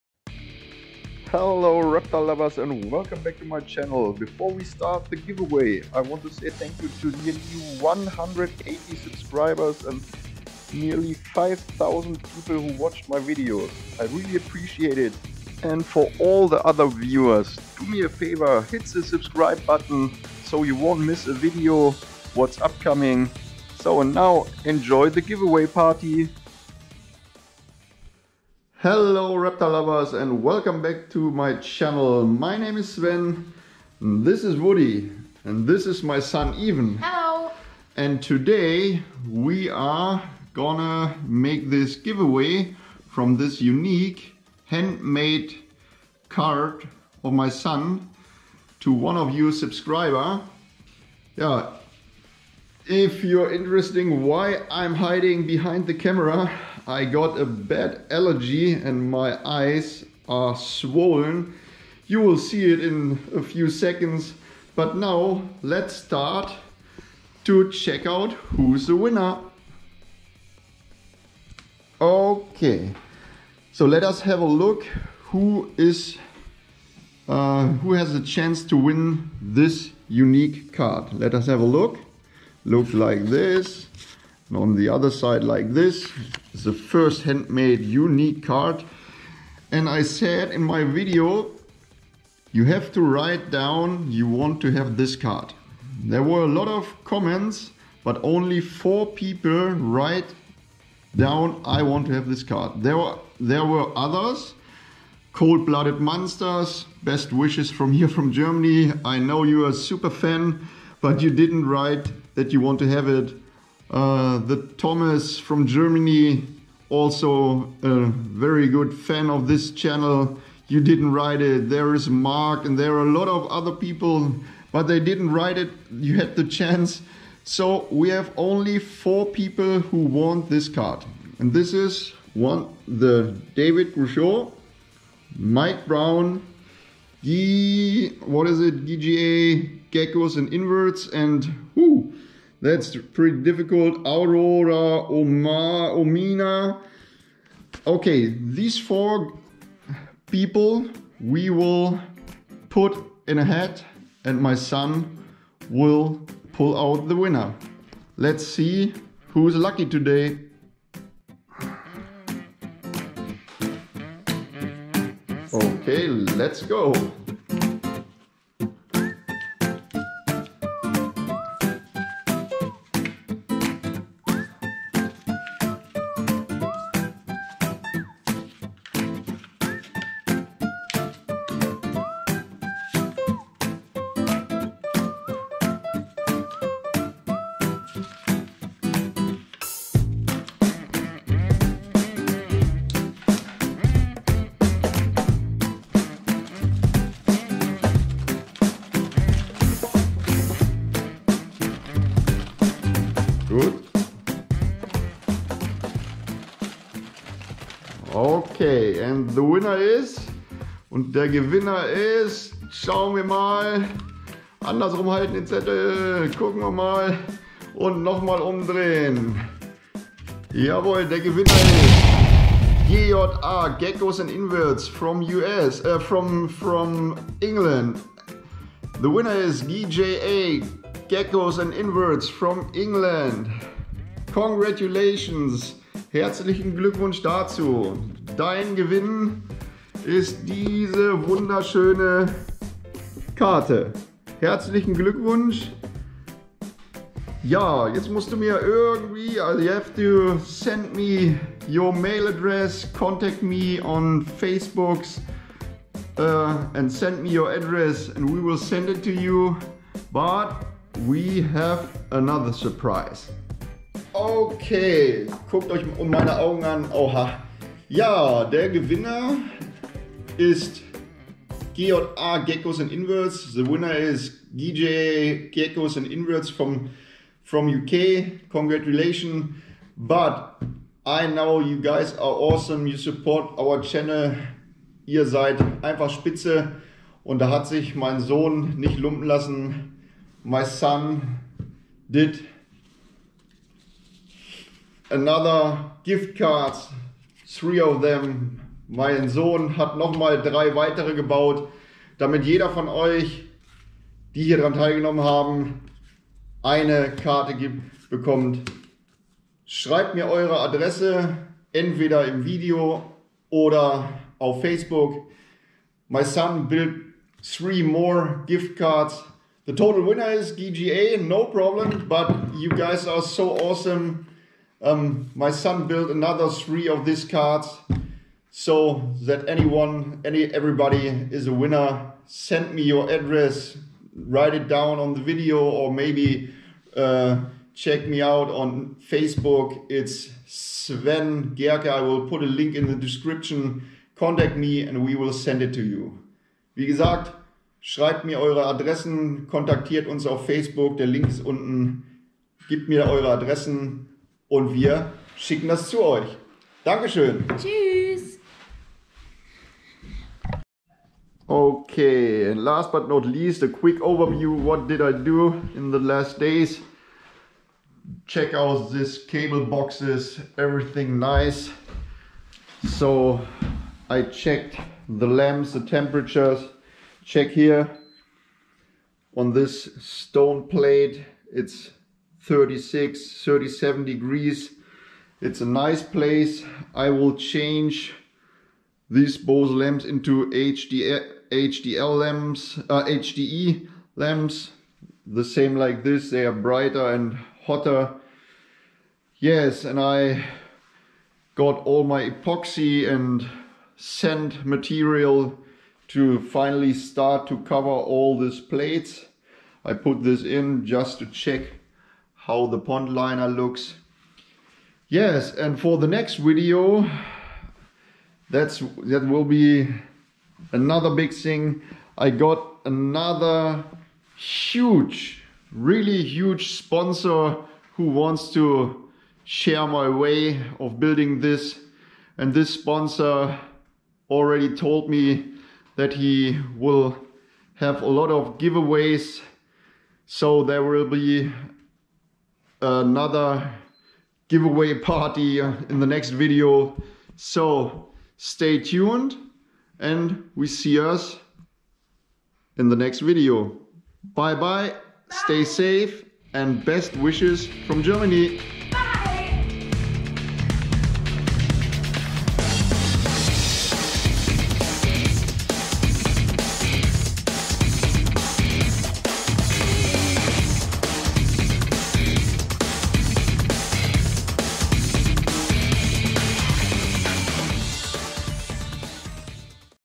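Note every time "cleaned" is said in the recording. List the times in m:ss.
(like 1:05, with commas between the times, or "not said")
not said.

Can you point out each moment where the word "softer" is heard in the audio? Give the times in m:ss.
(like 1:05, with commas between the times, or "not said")
not said.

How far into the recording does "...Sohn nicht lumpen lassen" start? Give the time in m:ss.
4:48.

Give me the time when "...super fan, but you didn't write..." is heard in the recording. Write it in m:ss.
1:49.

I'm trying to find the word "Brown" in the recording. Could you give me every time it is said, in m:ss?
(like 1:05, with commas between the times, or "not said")
2:15.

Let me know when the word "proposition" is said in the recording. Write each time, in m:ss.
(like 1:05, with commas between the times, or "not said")
not said.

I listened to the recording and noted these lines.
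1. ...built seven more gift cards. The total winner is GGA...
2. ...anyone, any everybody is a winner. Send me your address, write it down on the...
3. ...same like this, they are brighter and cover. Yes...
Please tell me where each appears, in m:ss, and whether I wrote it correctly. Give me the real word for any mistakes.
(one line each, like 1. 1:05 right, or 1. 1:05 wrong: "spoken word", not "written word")
1. 5:16 wrong: "three", not "seven"
2. 5:29 right
3. 6:35 wrong: "hotter", not "cover".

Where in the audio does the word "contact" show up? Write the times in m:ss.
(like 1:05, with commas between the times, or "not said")
4:12, 5:44.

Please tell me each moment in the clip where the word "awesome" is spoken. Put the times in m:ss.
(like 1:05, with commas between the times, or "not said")
4:42, 5:23.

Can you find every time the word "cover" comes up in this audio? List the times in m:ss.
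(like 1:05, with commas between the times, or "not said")
6:47.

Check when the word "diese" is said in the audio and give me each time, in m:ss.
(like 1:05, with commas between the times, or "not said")
4:00.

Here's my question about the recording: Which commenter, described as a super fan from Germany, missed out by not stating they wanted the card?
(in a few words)
Cold-Blooded Monsters.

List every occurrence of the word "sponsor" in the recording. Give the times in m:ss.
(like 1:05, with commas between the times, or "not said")
7:06, 7:12.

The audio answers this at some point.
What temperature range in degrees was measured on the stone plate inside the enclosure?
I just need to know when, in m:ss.
6:22.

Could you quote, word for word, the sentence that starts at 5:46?
Wie gesagt, schreibt mir eure Adressen, kontaktiert uns auf Facebook.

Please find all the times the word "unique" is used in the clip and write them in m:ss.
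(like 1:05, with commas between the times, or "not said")
0:43, 1:20, 1:27.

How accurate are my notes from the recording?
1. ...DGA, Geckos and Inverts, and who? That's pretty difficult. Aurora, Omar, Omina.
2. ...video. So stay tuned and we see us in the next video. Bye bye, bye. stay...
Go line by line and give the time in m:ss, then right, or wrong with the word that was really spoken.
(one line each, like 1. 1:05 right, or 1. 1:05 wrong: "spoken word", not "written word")
1. 2:18 right
2. 7:26 right.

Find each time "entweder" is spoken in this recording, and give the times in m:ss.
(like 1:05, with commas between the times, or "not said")
5:11.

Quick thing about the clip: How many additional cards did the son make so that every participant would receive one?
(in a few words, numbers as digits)
3.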